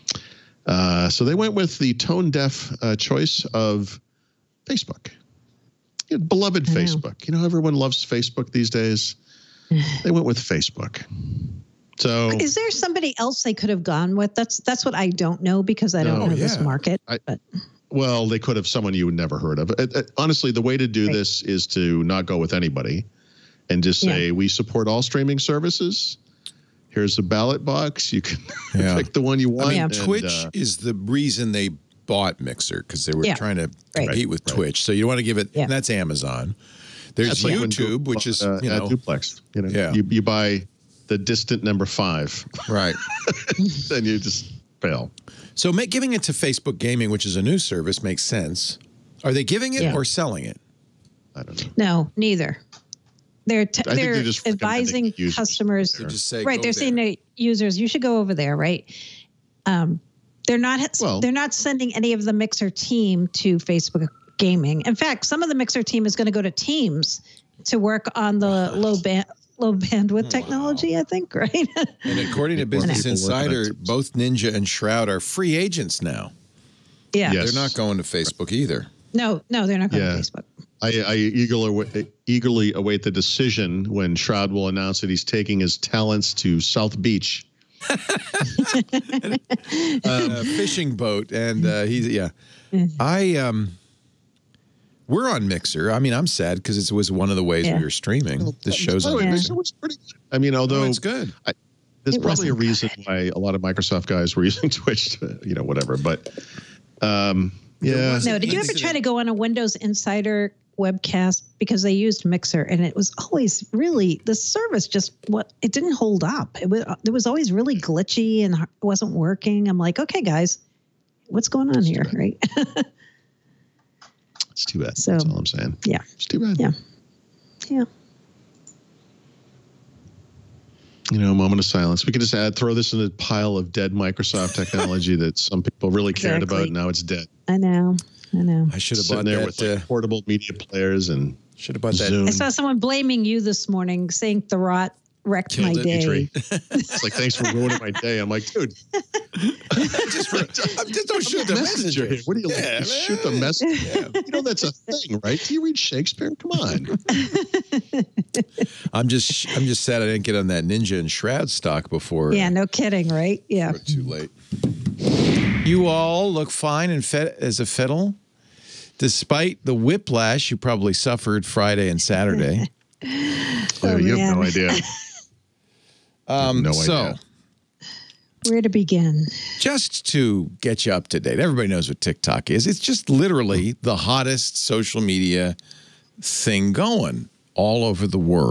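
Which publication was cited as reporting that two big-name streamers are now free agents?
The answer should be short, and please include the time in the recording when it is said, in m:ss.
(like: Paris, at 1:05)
Business Insider, at 1:12.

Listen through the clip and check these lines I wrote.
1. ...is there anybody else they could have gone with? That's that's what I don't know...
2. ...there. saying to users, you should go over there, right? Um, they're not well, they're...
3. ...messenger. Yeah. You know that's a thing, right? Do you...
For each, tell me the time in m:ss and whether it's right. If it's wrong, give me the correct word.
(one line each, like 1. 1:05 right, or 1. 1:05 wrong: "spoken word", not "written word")
1. 0:12 wrong: "somebody", not "anybody"
2. 0:56 right
3. 2:33 right.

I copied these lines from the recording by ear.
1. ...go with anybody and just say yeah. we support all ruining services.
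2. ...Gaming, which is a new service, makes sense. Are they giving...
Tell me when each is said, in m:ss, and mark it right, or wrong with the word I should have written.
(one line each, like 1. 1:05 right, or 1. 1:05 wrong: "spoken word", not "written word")
1. 0:22 wrong: "streaming", not "ruining"
2. 0:46 right.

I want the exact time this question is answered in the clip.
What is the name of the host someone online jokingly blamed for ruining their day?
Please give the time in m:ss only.
2:24.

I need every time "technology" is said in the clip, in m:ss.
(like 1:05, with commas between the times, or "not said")
1:10, 2:14.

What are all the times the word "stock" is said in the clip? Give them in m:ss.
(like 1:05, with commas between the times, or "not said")
2:41.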